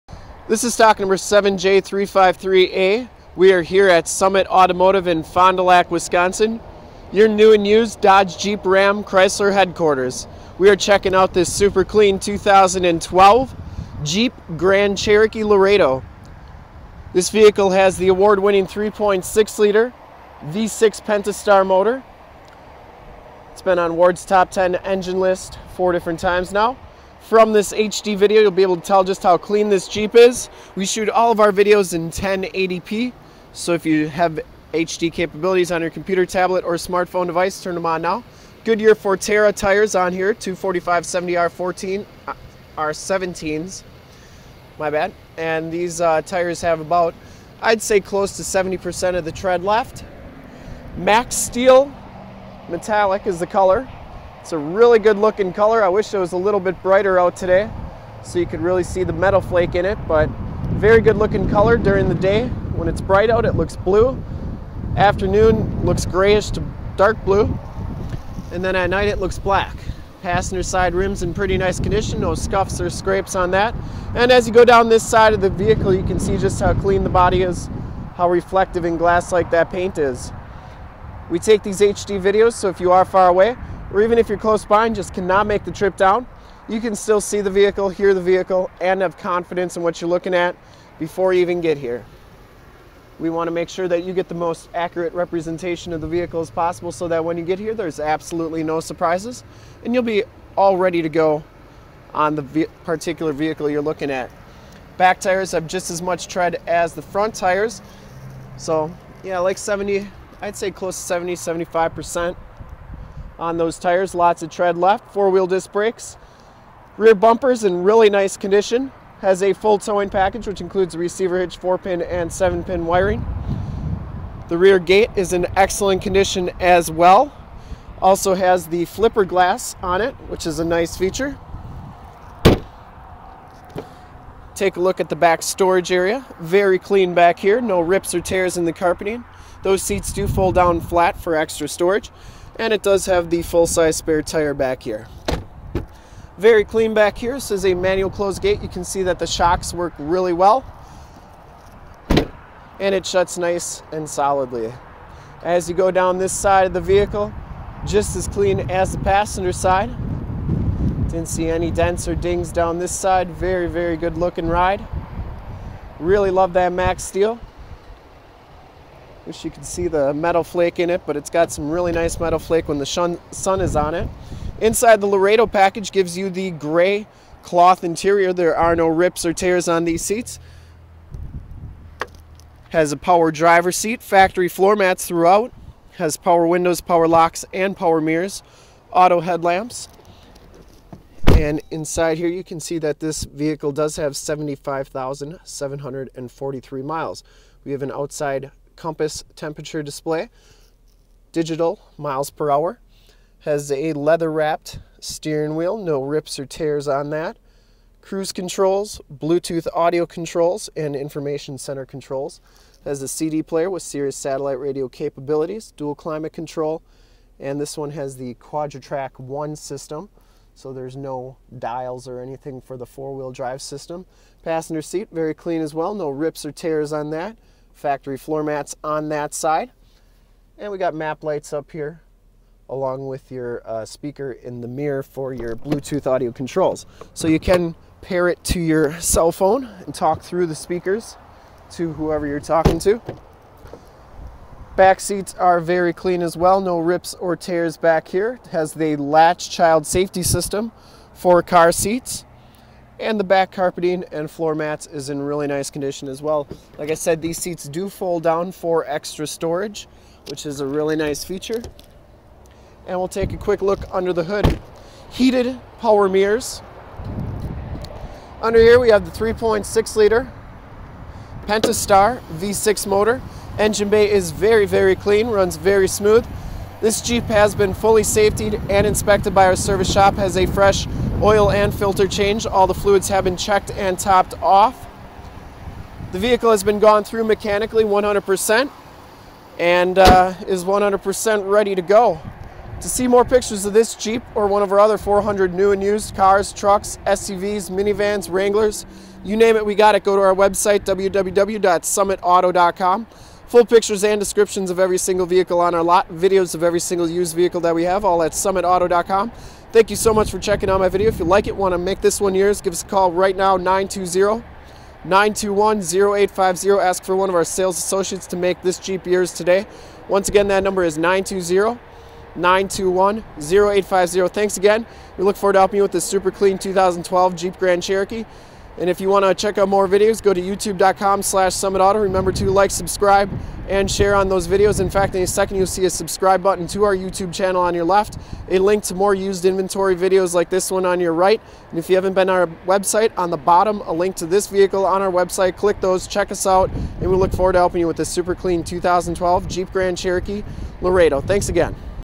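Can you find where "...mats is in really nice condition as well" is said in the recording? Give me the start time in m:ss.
4:14.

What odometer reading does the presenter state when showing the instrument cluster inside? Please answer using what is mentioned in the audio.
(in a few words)
75,743 miles.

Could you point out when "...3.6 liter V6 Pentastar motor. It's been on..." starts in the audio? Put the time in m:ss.
0:18.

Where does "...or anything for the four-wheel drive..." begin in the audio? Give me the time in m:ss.
3:42.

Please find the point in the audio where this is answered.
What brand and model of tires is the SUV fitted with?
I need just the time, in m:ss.
0:38.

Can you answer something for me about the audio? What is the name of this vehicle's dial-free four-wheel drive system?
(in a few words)
Quadra-Trac 1.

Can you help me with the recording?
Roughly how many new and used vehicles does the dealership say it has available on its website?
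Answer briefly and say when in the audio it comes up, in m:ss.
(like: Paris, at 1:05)
400, at 4:54.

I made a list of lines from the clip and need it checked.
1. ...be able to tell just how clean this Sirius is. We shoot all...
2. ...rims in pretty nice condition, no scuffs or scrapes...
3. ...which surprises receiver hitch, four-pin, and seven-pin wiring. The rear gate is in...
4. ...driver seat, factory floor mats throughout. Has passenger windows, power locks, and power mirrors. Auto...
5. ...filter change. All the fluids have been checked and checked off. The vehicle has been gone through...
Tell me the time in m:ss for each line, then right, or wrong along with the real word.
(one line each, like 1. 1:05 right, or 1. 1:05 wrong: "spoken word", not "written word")
1. 0:28 wrong: "Jeep", not "Sirius"
2. 1:10 right
3. 2:00 wrong: "includes", not "surprises"
4. 3:03 wrong: "power", not "passenger"
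5. 4:41 wrong: "topped", not "checked".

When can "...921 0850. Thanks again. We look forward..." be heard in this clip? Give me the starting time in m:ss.
5:22.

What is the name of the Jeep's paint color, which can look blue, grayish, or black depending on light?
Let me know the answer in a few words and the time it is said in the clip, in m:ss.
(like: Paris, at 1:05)
Max Steel Metallic, at 0:50.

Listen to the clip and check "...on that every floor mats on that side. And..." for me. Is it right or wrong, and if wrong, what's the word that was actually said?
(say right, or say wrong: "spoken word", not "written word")
wrong: "factory", not "every".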